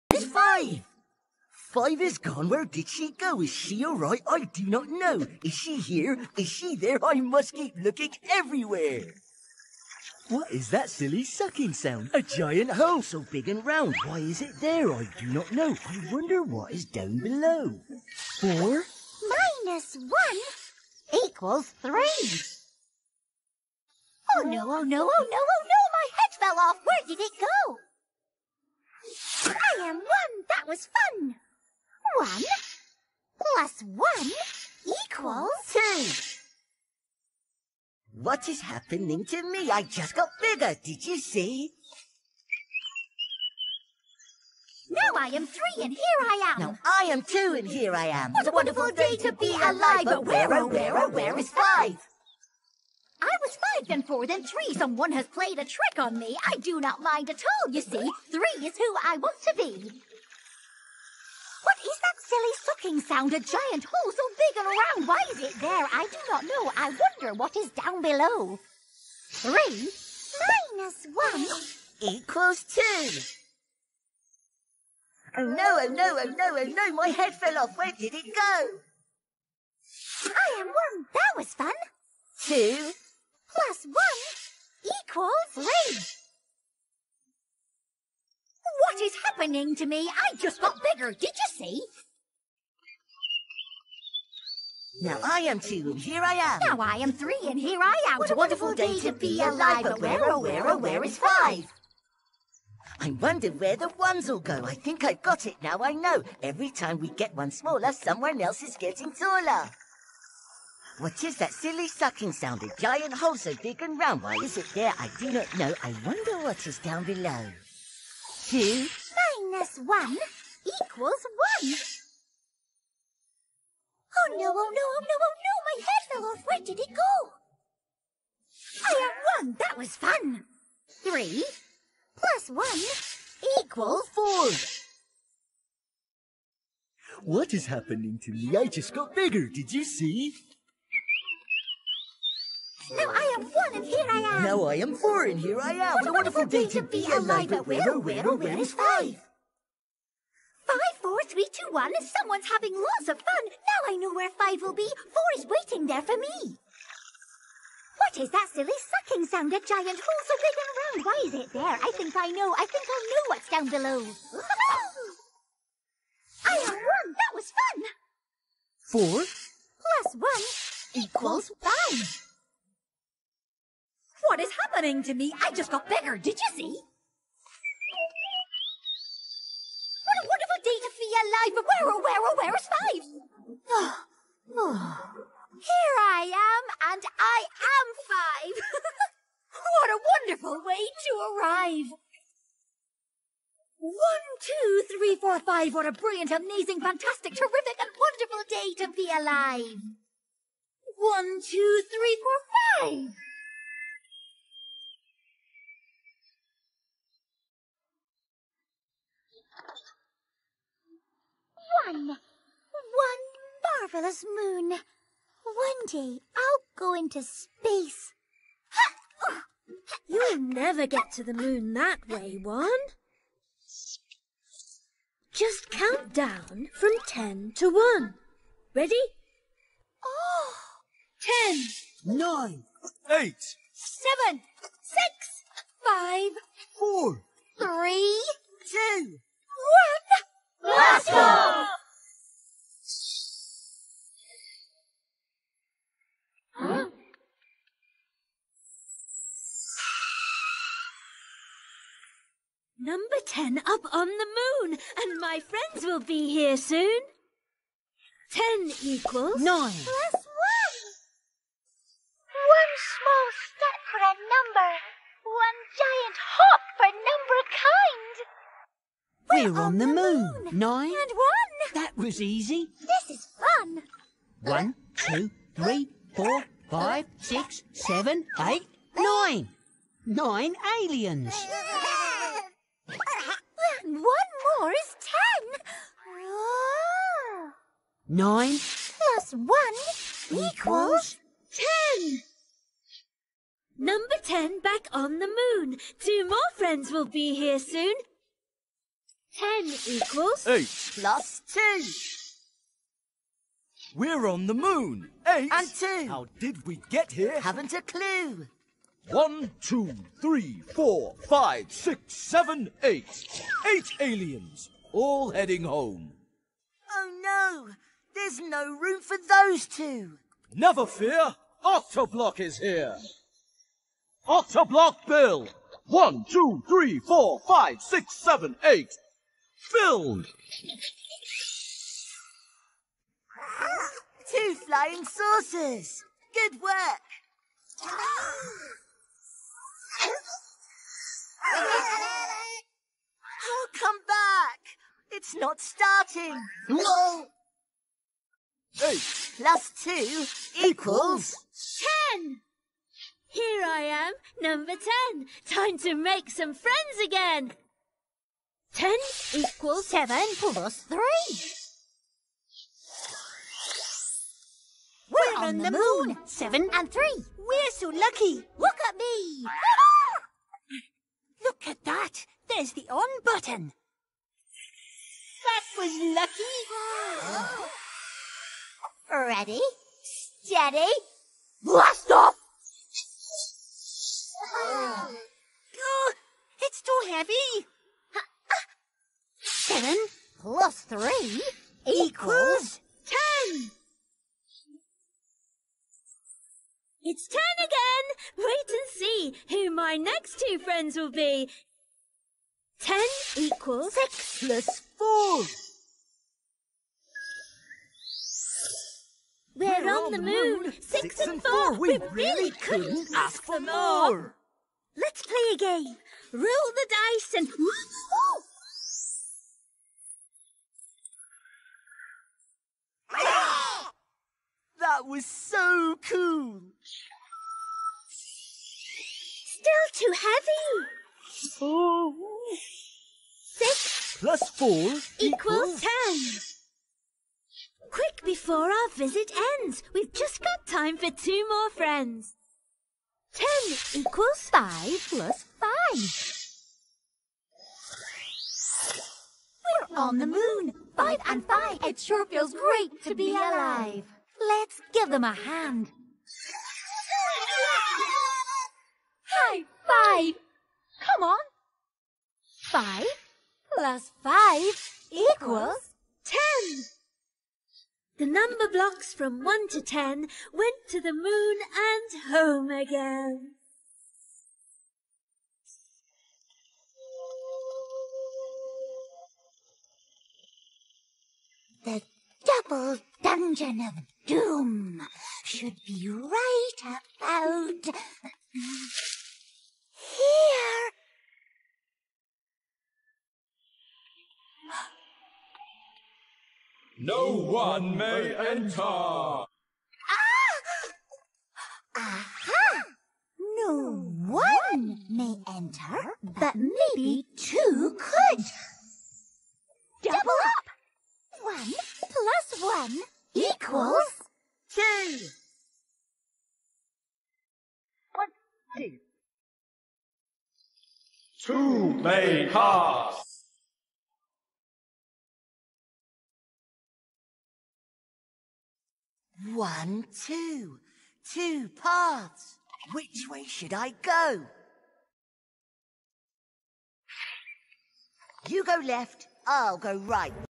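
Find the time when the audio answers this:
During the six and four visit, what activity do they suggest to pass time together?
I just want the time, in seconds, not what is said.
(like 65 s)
416 s.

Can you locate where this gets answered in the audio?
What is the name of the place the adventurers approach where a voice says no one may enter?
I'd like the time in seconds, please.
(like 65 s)
482 s.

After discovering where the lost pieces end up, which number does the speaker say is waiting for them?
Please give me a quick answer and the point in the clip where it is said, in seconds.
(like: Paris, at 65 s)
4, at 155 s.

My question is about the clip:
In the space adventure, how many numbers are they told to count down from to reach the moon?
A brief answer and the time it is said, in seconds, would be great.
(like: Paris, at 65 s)
10, at 225 s.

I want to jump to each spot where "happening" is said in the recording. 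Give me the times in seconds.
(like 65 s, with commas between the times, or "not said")
38 s, 89 s, 137 s, 174 s.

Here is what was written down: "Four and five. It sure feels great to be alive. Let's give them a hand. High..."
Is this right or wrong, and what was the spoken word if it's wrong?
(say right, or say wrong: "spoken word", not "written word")
wrong: "Five", not "Four".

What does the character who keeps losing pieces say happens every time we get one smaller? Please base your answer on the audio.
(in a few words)
someone else is getting taller.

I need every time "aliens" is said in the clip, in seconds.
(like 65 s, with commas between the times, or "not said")
280 s, 313 s.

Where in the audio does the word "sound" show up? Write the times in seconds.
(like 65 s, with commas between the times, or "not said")
11 s, 63 s, 112 s, 159 s.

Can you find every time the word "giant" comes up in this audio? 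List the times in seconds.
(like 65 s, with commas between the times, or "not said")
12 s, 63 s, 112 s, 159 s, 265 s.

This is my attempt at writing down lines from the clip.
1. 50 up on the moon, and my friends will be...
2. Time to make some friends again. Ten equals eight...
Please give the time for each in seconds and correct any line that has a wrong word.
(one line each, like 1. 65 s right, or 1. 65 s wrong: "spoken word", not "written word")
1. 253 s wrong: "10", not "50"
2. 355 s wrong: "seven", not "eight".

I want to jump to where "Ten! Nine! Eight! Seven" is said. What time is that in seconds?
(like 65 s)
231 s.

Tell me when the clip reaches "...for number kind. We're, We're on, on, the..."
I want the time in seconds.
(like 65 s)
269 s.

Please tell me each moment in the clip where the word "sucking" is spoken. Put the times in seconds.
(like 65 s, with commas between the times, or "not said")
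11 s, 62 s, 111 s, 158 s.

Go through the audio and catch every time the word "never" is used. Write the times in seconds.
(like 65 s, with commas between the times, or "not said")
220 s, 320 s.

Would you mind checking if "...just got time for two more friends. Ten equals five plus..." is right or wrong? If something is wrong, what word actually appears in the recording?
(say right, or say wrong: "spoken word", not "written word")
right.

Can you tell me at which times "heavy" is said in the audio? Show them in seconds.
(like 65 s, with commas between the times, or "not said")
387 s, 430 s.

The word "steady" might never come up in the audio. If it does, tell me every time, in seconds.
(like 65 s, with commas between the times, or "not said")
380 s.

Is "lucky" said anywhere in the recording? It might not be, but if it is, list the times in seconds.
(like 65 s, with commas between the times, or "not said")
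367 s, 376 s.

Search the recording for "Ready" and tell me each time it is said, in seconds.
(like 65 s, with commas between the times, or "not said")
228 s, 379 s.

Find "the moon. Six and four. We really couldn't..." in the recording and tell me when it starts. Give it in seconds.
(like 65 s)
410 s.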